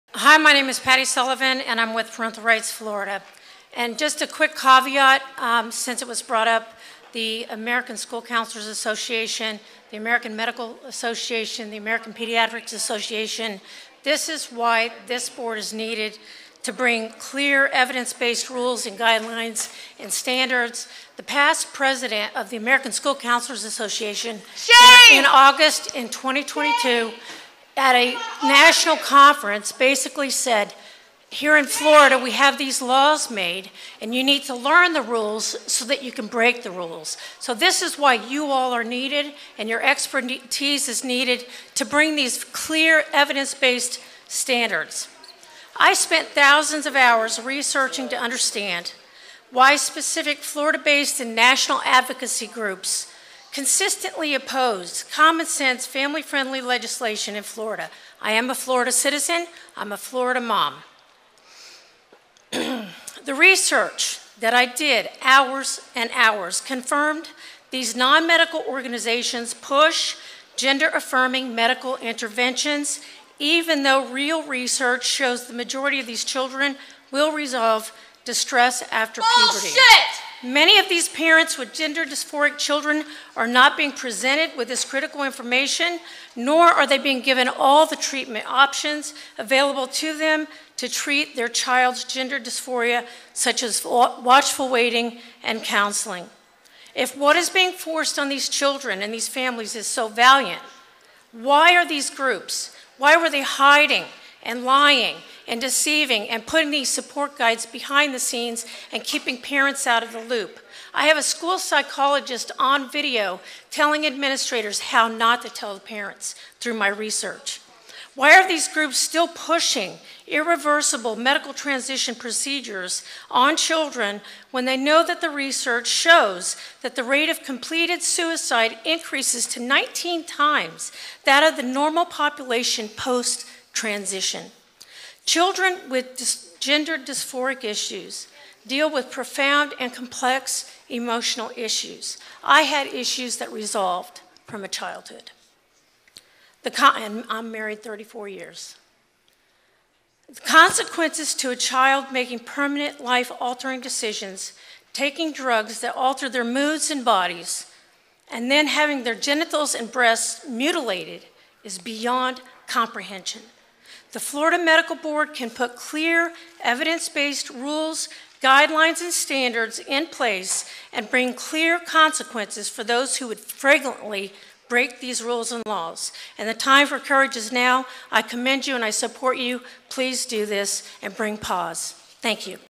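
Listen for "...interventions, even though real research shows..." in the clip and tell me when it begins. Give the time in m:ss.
1:11.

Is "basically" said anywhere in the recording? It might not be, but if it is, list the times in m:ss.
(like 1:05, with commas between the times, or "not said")
0:29.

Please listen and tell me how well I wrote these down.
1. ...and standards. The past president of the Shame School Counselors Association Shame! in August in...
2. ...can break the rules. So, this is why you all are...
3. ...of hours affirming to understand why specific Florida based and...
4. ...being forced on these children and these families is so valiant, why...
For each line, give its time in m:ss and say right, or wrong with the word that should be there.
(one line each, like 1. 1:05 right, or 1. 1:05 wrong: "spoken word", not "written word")
1. 0:19 wrong: "American", not "Shame"
2. 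0:36 right
3. 0:46 wrong: "researching", not "affirming"
4. 1:37 right.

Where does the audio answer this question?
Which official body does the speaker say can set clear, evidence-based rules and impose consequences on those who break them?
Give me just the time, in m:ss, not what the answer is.
2:44.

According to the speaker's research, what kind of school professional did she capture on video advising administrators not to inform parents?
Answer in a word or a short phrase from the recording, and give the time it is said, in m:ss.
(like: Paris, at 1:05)
school psychologist, at 1:51.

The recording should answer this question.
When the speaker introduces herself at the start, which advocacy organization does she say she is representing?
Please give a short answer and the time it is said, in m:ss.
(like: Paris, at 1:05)
Parental Rights Florida, at 0:02.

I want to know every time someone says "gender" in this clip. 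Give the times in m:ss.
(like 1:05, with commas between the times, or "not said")
1:10, 1:21, 1:32, 2:16.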